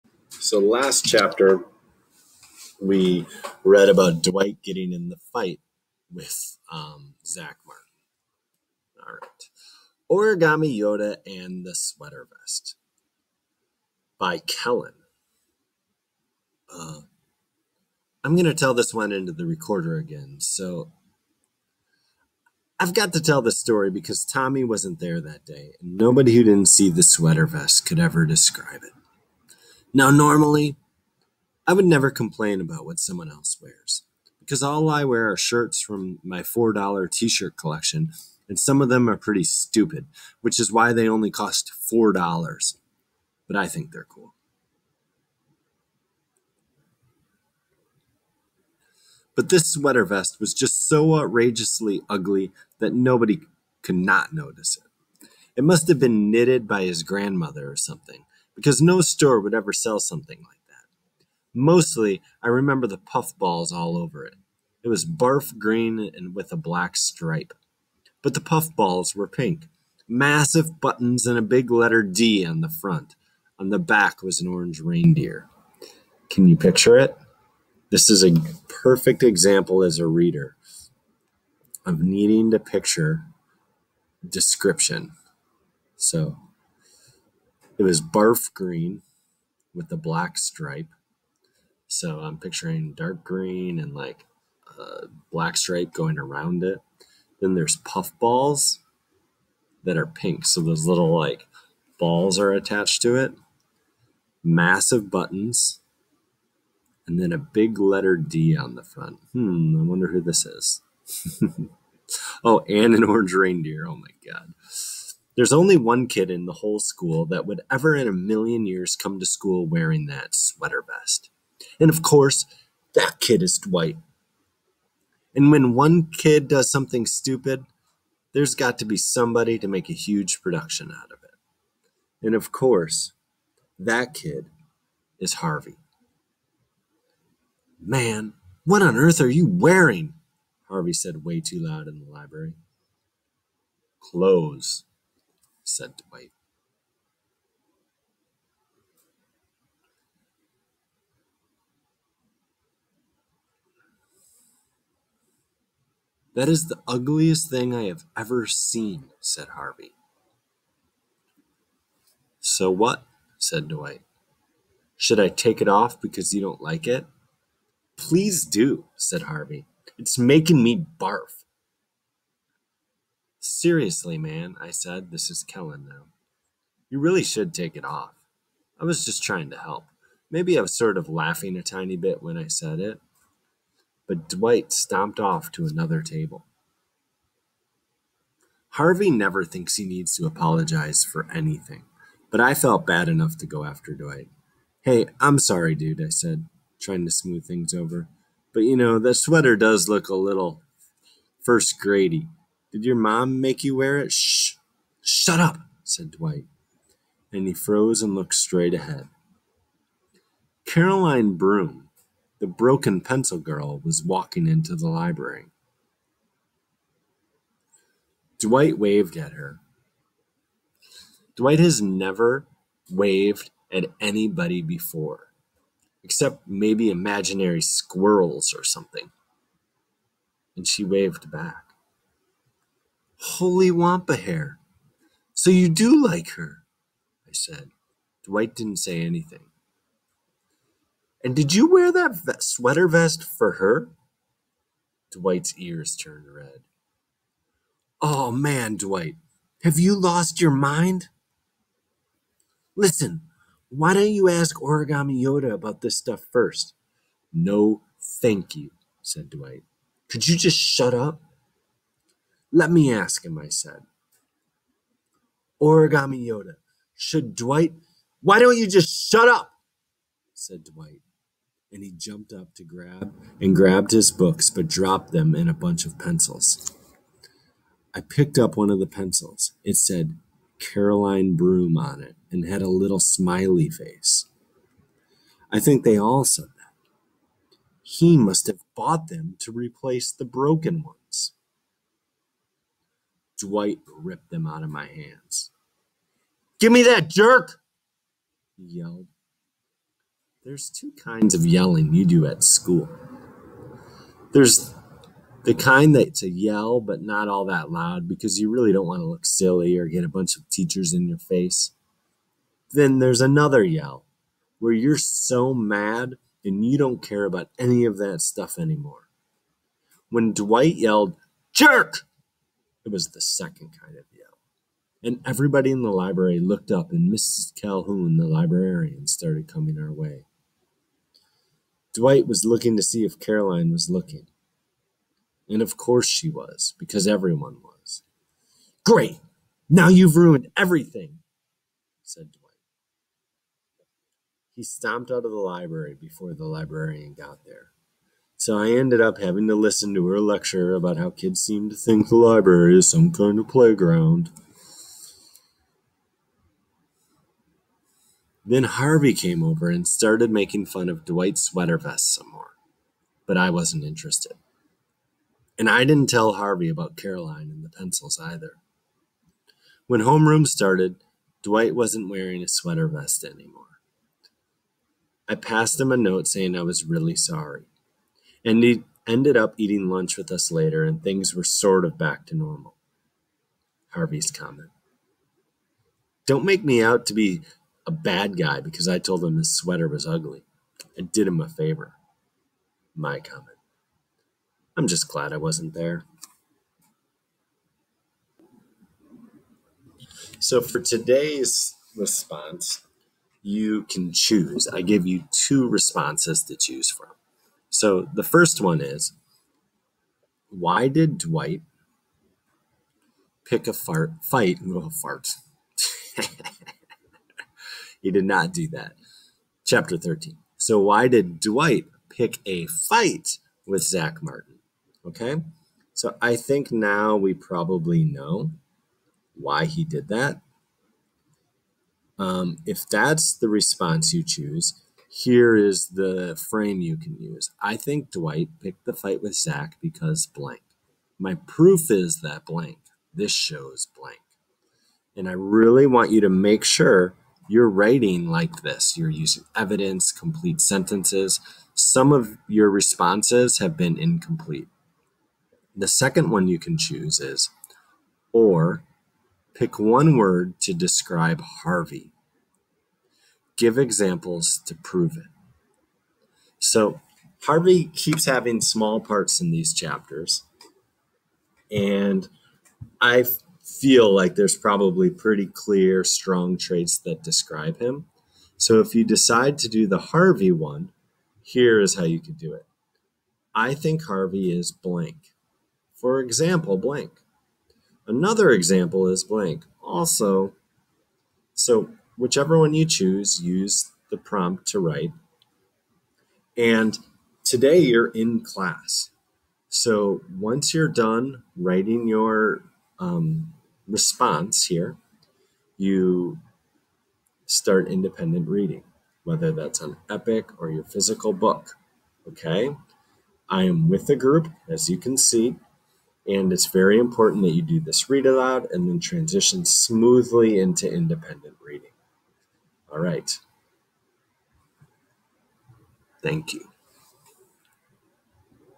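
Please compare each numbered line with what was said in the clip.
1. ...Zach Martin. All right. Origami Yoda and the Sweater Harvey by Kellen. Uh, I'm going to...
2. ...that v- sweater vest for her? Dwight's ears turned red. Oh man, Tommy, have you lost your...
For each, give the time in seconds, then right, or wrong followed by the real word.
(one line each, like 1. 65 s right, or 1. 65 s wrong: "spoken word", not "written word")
1. 7 s wrong: "Vest", not "Harvey"
2. 241 s wrong: "Dwight", not "Tommy".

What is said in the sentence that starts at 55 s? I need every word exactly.
It must have been knitted by his grandmother or something, because no store would ever sell something like that.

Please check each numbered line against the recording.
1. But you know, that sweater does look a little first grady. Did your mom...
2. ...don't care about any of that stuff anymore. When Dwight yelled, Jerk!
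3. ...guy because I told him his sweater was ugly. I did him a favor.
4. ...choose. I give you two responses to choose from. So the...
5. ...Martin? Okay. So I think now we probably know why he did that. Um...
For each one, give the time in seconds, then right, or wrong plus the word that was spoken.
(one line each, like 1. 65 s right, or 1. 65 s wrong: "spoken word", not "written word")
1. 198 s right
2. 316 s right
3. 388 s right
4. 404 s right
5. 424 s right.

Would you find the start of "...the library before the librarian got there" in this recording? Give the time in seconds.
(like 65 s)
345 s.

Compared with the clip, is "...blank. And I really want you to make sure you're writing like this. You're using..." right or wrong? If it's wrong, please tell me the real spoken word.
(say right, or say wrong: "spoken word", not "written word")
right.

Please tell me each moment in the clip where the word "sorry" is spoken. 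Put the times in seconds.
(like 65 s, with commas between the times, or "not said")
195 s, 377 s.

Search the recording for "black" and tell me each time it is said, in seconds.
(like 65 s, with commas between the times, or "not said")
66 s, 89 s, 95 s.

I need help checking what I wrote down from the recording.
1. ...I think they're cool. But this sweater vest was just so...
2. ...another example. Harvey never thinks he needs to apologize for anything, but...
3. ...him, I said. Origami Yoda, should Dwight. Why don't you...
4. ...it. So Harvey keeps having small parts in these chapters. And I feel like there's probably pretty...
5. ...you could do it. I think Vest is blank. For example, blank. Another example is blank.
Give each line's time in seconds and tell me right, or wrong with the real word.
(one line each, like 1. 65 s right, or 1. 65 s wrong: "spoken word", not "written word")
1. 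43 s right
2. 185 s wrong: "table", not "example"
3. 263 s right
4. 465 s right
5. 482 s wrong: "Harvey", not "Vest".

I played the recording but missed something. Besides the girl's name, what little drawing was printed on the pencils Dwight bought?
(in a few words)
Smiley face.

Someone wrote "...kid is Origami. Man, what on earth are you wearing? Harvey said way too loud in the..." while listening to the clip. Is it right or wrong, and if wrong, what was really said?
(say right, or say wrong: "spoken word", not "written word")
wrong: "Harvey", not "Origami".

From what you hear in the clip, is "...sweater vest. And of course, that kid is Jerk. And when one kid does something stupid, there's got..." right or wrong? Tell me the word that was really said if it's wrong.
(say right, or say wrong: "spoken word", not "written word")
wrong: "Dwight", not "Jerk".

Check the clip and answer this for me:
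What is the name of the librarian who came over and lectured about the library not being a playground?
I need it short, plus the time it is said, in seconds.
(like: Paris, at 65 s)
Mrs. Calhoun, at 327 s.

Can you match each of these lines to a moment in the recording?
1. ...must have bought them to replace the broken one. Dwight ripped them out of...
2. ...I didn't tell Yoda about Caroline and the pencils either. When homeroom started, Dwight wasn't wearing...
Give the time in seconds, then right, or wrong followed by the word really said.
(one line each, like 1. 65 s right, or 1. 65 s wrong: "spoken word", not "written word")
1. 288 s right
2. 365 s wrong: "Harvey", not "Yoda".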